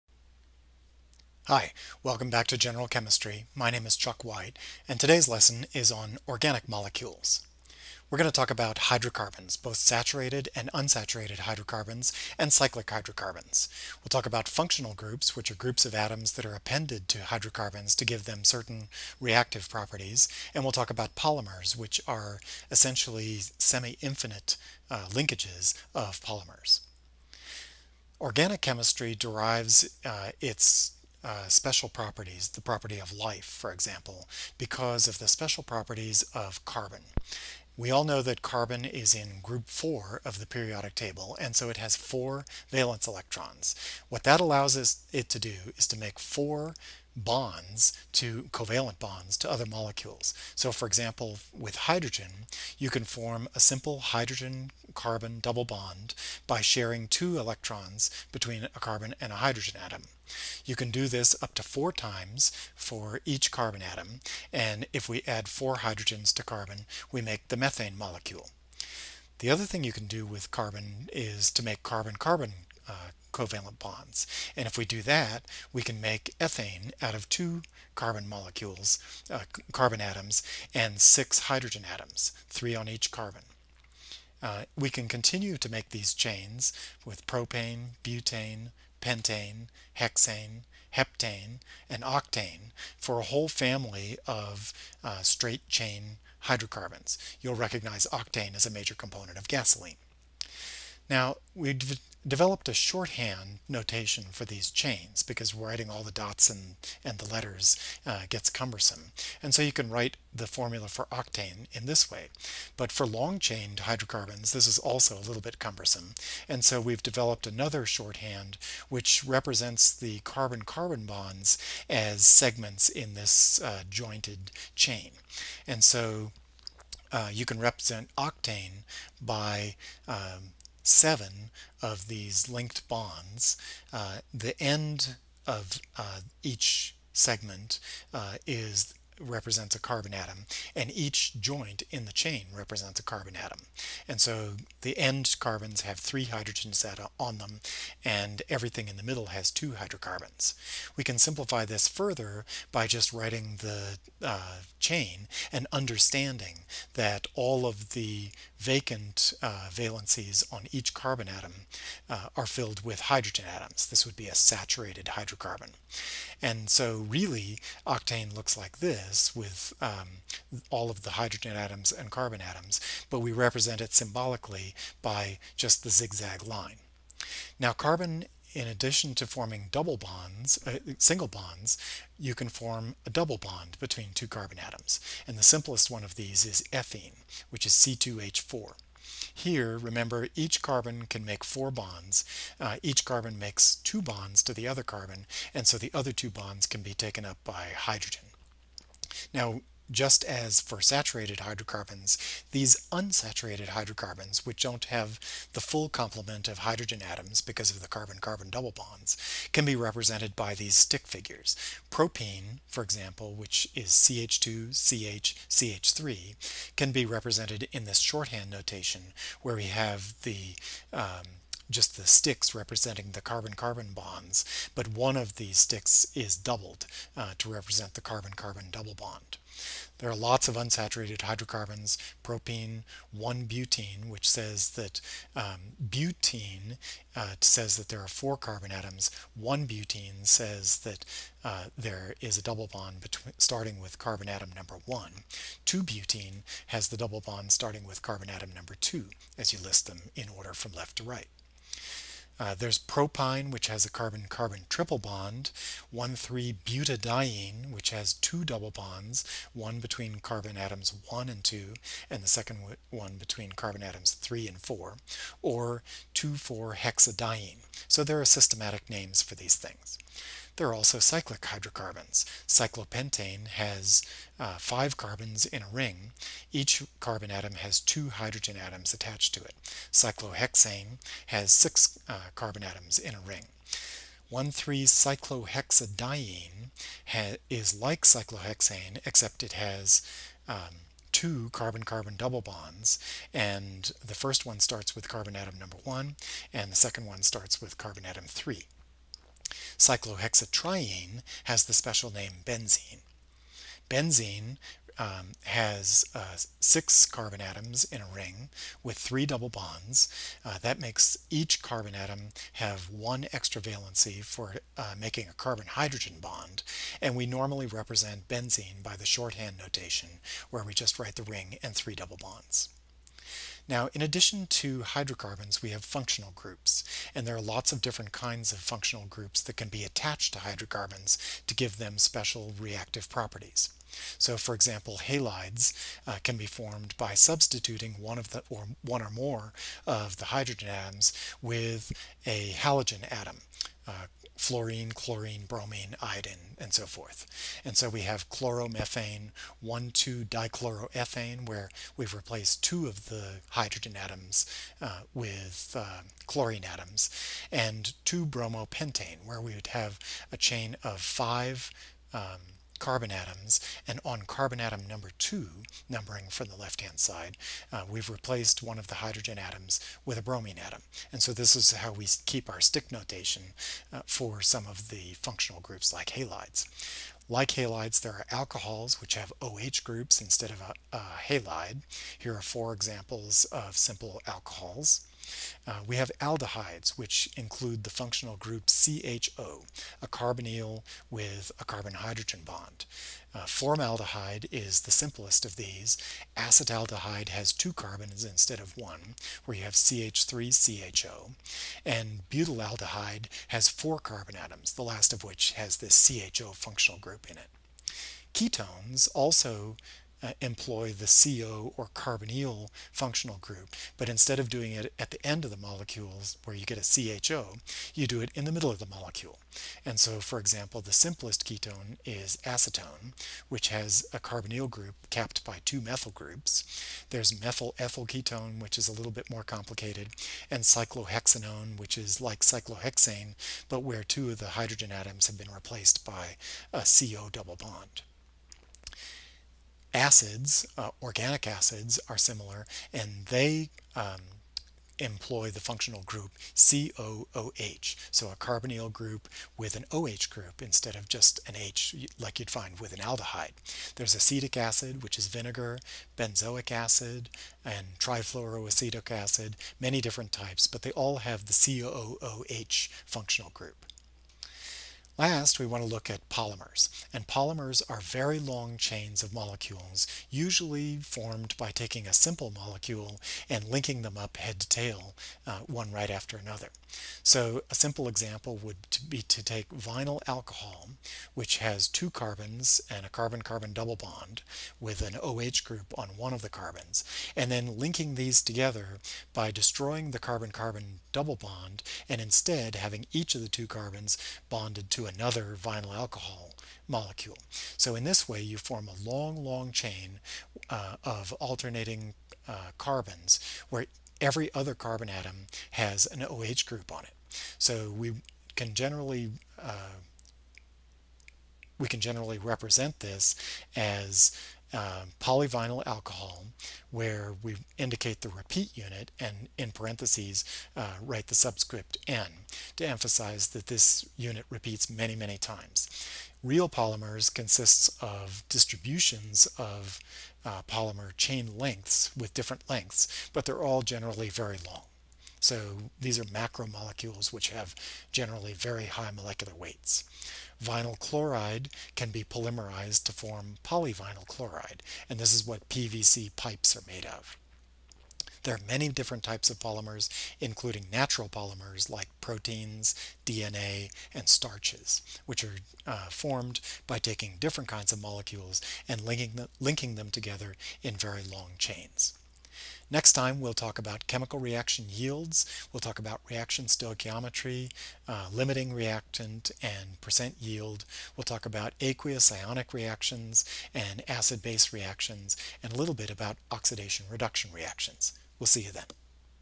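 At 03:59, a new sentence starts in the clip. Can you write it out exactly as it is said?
1-butene says that uh, there is a double bond between, starting with carbon atom number 1.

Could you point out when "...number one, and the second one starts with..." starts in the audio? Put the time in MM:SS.
04:55.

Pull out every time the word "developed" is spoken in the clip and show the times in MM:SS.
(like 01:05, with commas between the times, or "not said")
01:42, 01:57.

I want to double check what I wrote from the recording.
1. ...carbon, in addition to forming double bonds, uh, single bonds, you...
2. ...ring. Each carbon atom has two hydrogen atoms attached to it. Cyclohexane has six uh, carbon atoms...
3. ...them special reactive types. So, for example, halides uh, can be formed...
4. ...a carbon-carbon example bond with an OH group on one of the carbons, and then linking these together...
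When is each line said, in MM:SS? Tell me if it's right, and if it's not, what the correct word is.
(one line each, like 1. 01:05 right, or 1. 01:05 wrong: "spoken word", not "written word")
1. 02:57 right
2. 04:35 right
3. 05:31 wrong: "properties", not "types"
4. 08:03 wrong: "double", not "example".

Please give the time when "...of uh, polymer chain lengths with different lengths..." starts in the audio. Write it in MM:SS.
08:49.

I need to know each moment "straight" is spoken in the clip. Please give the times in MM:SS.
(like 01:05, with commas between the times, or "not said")
01:35.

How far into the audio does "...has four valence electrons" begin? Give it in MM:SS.
00:41.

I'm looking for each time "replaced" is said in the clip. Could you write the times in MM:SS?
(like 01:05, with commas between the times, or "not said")
05:52, 06:08, 07:15.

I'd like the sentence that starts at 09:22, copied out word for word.
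Next time, we'll talk about chemical reaction yields.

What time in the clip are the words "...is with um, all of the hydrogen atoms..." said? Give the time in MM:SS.
02:49.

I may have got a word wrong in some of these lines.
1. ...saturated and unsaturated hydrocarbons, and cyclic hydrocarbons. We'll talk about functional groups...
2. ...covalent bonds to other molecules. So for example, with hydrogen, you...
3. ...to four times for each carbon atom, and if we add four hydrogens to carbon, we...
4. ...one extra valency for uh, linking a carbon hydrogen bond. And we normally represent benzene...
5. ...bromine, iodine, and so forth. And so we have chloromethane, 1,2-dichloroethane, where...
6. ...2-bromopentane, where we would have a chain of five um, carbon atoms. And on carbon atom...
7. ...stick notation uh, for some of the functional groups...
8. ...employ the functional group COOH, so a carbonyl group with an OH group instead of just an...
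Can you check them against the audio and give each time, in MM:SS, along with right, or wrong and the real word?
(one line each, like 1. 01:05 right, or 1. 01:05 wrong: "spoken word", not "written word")
1. 00:09 right
2. 00:48 right
3. 01:01 right
4. 05:12 wrong: "making", not "linking"
5. 05:45 right
6. 05:58 right
7. 06:12 right
8. 07:24 right.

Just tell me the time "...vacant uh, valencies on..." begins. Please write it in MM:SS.
02:38.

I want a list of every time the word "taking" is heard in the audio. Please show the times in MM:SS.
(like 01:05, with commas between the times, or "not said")
07:51, 09:16.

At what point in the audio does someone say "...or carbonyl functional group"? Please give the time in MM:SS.
06:51.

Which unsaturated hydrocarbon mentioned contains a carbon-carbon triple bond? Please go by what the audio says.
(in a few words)
propyne.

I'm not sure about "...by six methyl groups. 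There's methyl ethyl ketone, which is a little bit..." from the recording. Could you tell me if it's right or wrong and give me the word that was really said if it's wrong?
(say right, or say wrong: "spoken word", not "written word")
wrong: "two", not "six".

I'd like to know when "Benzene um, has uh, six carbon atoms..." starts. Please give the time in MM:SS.
05:03.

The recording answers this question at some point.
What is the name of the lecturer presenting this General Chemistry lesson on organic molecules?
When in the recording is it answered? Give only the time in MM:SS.
00:03.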